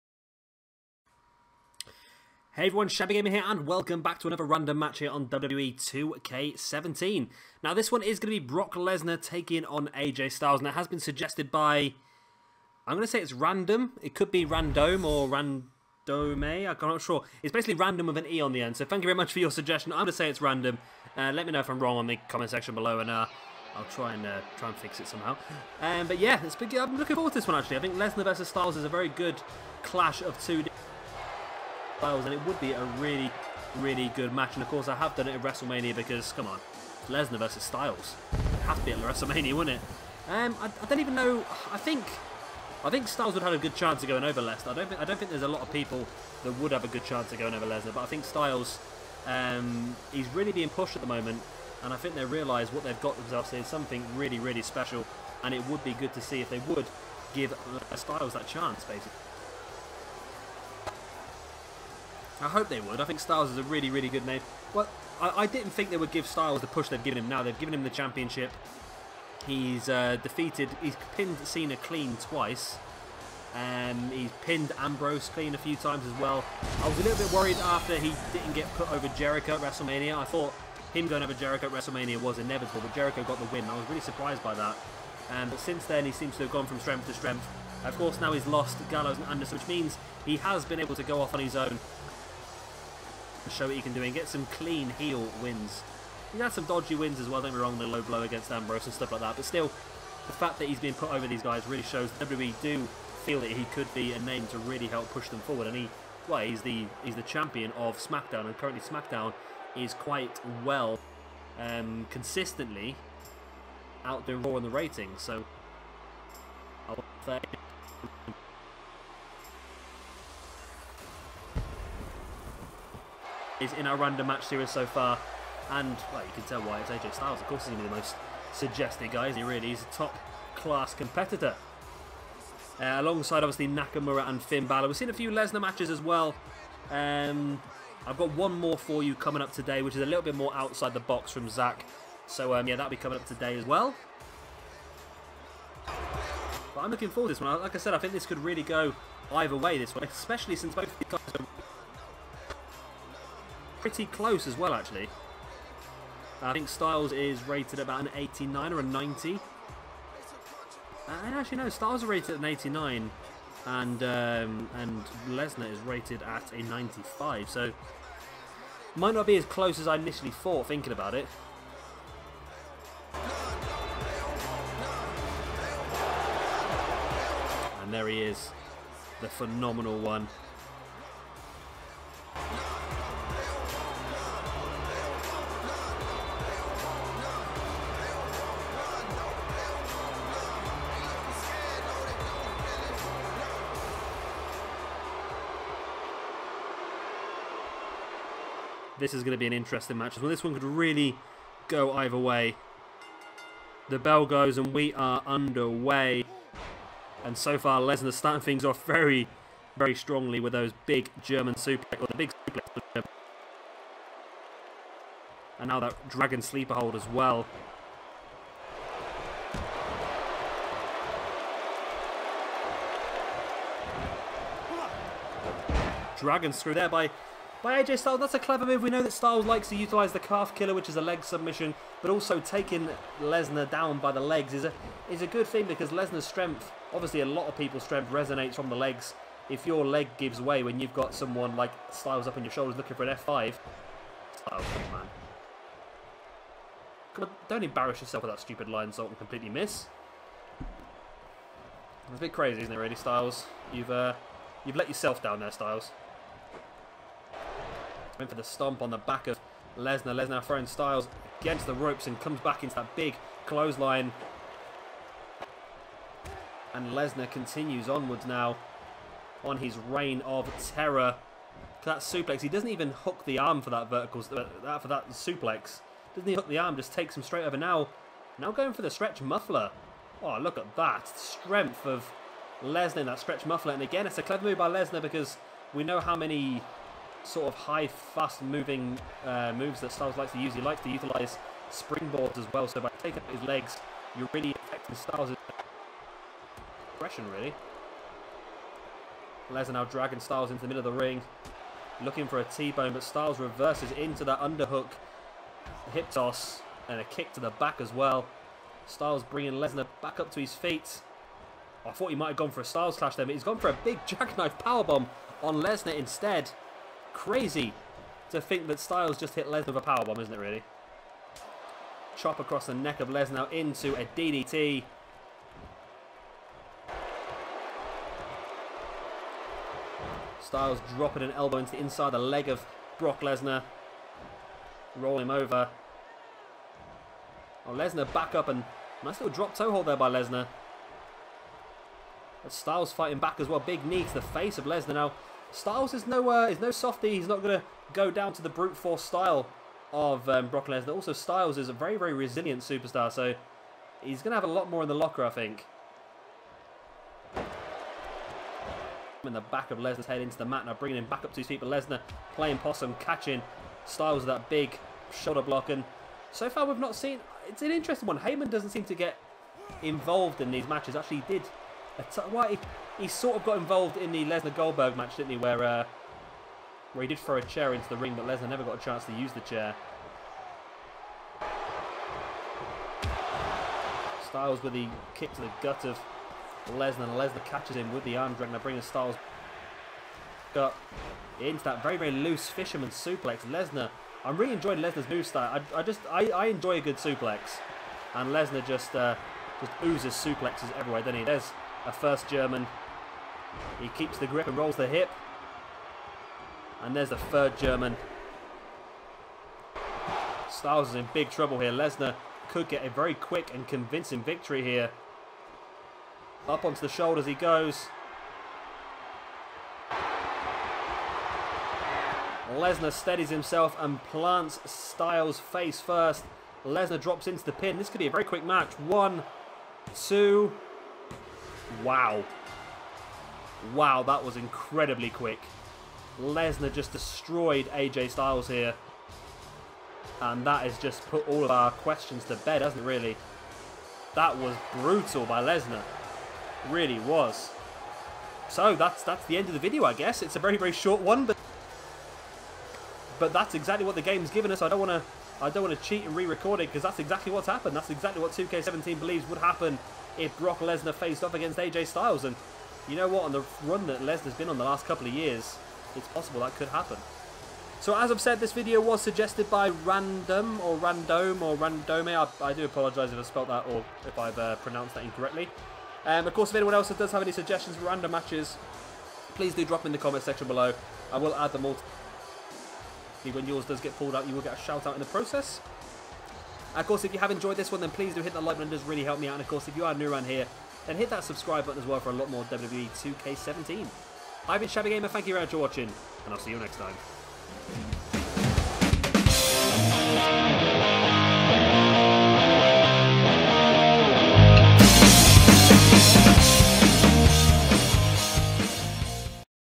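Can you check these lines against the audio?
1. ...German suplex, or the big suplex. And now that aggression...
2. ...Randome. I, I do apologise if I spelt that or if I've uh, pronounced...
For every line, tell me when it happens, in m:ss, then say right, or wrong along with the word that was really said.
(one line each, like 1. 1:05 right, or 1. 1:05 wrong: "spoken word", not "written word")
1. 3:31 wrong: "dragon", not "aggression"
2. 7:51 right.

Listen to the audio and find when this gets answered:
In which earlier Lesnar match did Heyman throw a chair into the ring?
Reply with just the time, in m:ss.
6:14.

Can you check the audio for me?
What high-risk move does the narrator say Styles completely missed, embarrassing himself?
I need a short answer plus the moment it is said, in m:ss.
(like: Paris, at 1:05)
lionsault, at 4:08.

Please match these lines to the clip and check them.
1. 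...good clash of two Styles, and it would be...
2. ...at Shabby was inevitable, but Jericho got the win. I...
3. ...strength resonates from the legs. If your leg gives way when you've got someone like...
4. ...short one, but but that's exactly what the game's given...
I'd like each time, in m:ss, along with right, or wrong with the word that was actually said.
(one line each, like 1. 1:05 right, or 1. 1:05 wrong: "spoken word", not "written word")
1. 0:29 right
2. 1:21 wrong: "WrestleMania", not "Shabby"
3. 3:57 right
4. 7:30 right.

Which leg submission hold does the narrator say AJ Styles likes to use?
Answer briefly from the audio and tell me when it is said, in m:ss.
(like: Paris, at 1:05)
calf killer, at 3:50.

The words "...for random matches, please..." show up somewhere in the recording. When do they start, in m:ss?
7:57.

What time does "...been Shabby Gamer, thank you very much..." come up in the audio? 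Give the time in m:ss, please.
8:14.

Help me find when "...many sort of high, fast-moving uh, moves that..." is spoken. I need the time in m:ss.
4:46.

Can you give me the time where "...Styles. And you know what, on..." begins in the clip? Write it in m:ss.
7:41.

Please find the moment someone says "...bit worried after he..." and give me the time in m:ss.
1:17.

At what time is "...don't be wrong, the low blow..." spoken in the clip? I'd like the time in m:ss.
1:37.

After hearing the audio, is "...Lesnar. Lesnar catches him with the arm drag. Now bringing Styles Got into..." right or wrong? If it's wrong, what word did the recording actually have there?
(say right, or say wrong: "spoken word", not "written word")
right.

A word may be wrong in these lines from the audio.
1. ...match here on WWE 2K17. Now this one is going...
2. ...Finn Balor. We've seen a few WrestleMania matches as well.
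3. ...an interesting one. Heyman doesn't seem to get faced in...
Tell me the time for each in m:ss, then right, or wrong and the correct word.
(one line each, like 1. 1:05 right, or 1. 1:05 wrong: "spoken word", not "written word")
1. 0:04 right
2. 2:14 wrong: "Lesnar", not "WrestleMania"
3. 6:07 wrong: "involved", not "faced".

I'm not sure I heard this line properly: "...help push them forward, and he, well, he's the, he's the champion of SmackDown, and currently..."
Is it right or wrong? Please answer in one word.
right.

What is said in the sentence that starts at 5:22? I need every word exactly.
Chop across the neck of Lesnar into a DDT.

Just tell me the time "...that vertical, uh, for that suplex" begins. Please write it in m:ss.
4:33.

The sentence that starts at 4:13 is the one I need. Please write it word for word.
You've uh, you've let yourself down there, Styles.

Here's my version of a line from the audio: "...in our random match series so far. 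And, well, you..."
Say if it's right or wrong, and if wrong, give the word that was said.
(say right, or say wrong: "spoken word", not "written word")
right.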